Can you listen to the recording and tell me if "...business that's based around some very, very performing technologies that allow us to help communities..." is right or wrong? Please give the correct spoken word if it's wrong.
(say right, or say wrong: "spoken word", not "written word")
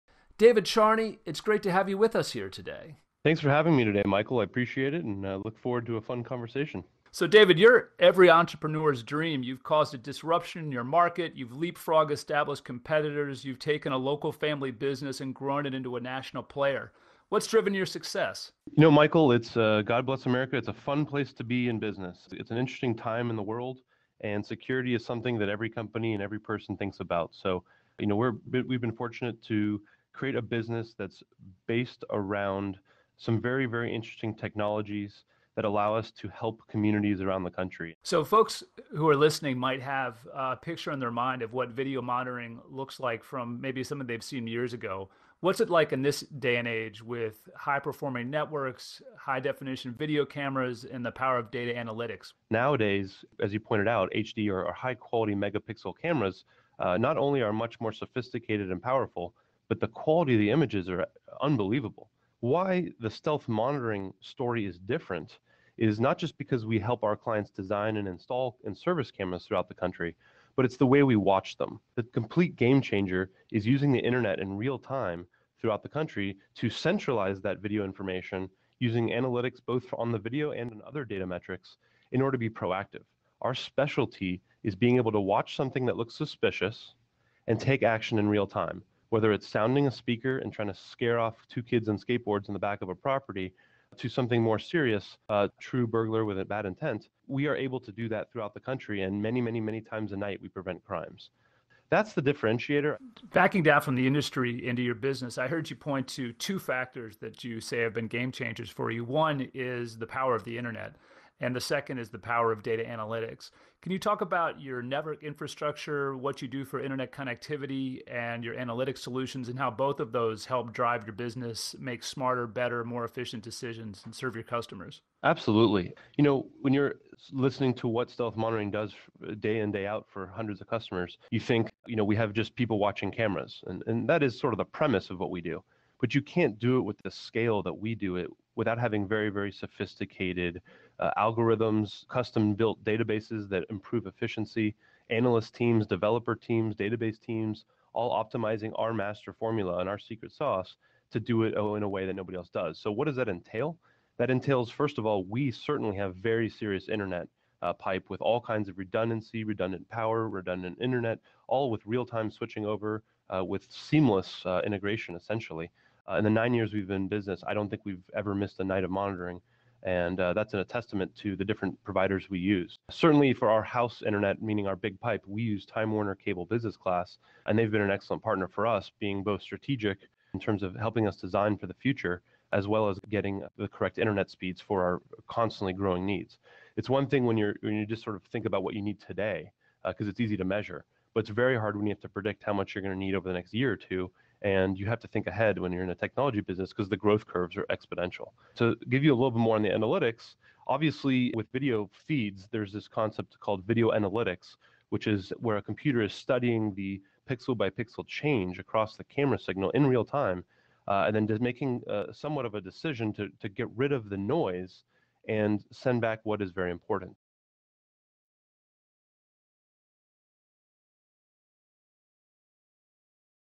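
wrong: "interesting", not "performing".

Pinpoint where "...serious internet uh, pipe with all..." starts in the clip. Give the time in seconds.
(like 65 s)
156 s.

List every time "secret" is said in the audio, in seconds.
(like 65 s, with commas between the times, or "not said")
149 s.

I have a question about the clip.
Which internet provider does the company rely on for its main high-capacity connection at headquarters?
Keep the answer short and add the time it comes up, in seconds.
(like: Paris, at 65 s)
Time Warner Cable Business Class, at 175 s.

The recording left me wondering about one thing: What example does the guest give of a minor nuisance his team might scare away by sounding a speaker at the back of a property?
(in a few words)
two kids on skateboards.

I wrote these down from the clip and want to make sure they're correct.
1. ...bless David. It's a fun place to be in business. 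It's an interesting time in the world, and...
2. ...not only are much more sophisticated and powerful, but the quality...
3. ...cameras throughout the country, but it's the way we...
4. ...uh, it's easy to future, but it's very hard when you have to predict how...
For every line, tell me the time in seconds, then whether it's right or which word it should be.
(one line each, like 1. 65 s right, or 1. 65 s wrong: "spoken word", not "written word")
1. 20 s wrong: "America", not "David"
2. 56 s right
3. 69 s right
4. 190 s wrong: "measure", not "future".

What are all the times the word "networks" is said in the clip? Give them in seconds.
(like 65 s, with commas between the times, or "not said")
48 s, 114 s.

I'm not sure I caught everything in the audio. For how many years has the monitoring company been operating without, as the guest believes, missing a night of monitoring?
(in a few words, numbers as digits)
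9.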